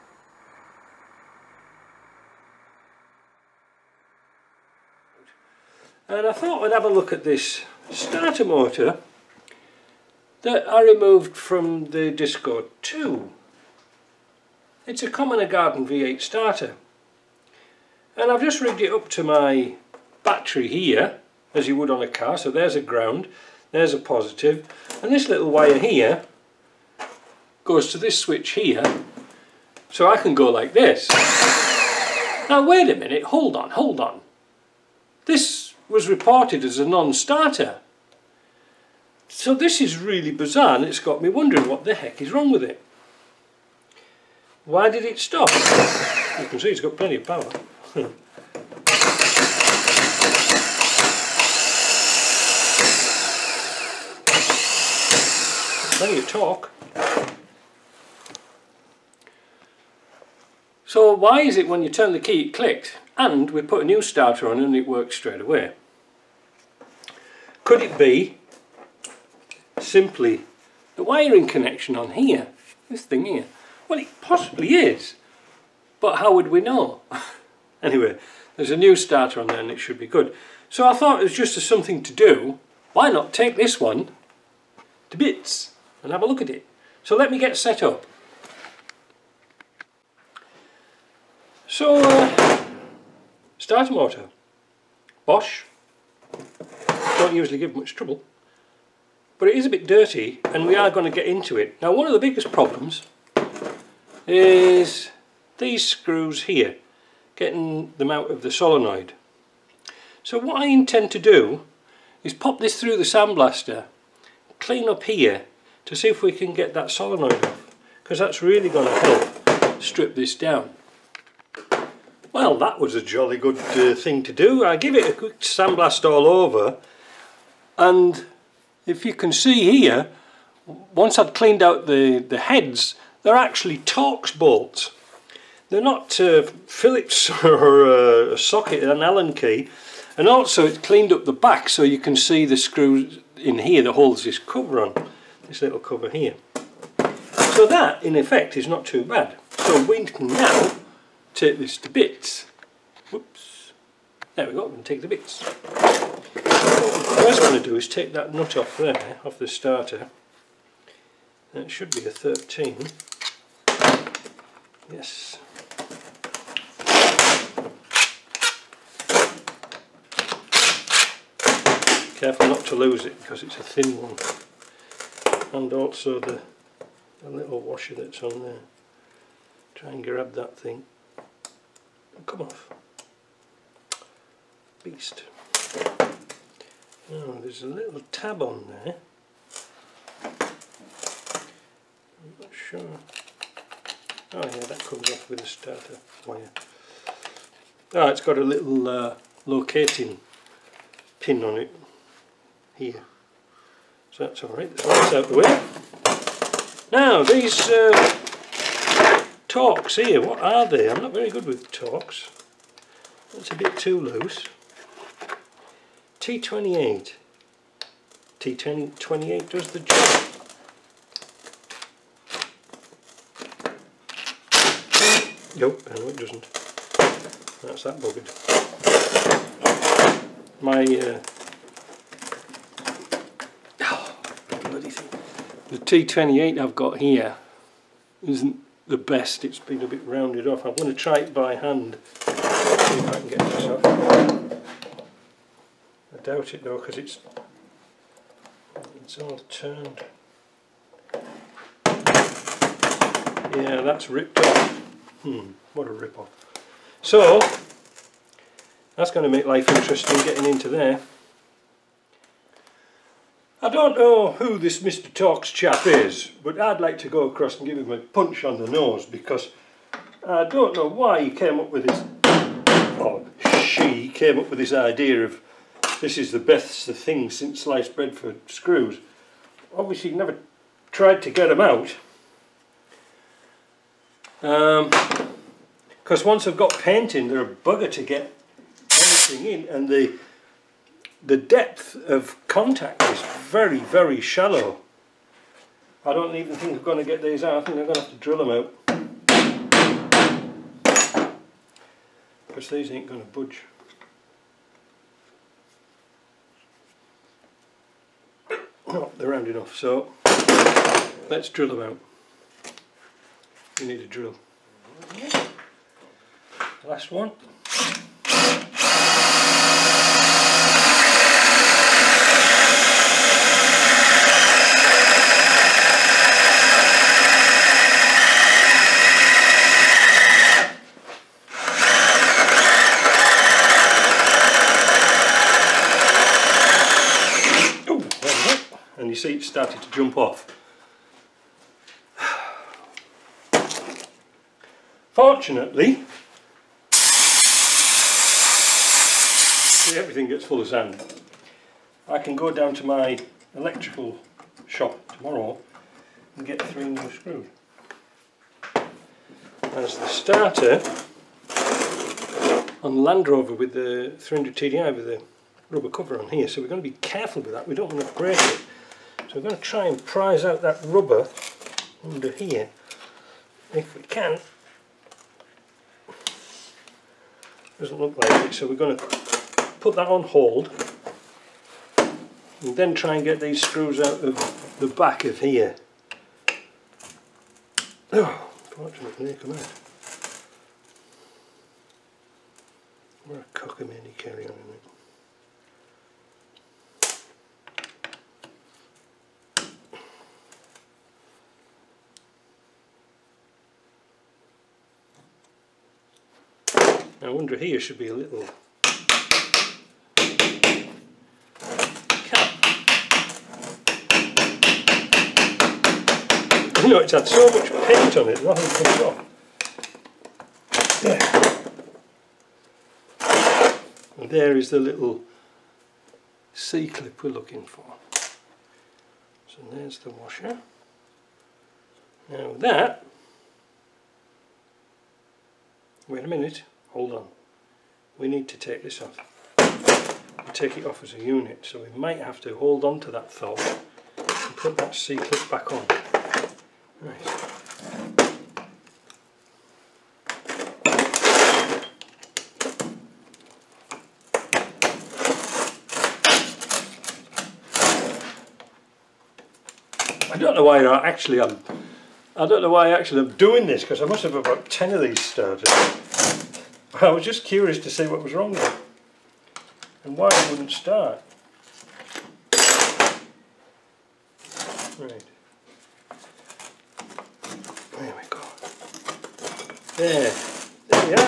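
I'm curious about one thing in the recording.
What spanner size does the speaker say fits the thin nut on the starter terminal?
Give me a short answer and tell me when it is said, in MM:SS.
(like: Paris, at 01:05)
13, at 02:42.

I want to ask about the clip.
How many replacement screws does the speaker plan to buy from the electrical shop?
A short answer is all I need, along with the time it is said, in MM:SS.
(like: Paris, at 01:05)
3, at 05:56.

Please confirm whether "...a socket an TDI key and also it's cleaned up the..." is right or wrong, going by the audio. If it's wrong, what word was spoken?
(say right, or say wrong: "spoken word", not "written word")
wrong: "Allen", not "TDI".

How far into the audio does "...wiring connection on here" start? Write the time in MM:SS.
01:11.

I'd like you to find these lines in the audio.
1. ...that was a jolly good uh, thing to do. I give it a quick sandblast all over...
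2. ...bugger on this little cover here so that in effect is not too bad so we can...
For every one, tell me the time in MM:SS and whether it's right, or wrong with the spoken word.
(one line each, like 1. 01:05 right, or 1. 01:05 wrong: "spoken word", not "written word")
1. 02:02 right
2. 02:24 wrong: "cover", not "bugger".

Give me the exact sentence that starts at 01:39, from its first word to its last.
But it is a bit dirty and we are going to get into it.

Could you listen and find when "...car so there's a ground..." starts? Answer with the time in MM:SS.
00:22.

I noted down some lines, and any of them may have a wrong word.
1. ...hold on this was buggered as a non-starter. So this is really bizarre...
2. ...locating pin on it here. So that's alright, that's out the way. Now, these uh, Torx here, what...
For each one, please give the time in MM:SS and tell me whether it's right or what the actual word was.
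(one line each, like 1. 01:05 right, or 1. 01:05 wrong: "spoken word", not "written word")
1. 00:33 wrong: "reported", not "buggered"
2. 03:19 right.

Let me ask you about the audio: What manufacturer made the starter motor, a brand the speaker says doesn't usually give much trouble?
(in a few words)
Bosch.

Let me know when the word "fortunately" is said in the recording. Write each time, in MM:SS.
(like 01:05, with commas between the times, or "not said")
05:45, 06:28.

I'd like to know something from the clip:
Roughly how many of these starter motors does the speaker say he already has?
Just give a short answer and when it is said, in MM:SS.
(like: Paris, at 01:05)
10, at 07:44.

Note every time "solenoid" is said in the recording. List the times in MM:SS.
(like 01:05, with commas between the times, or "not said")
01:48, 01:56.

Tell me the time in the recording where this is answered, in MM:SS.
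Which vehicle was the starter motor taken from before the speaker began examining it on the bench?
00:12.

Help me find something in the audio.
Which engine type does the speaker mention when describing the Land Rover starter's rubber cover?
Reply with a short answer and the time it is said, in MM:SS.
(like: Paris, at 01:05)
300 TDI, at 06:04.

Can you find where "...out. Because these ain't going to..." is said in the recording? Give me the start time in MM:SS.
04:58.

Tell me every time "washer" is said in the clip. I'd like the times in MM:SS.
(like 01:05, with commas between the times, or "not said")
02:57, 07:10.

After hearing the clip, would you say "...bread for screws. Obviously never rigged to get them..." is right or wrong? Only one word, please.
wrong.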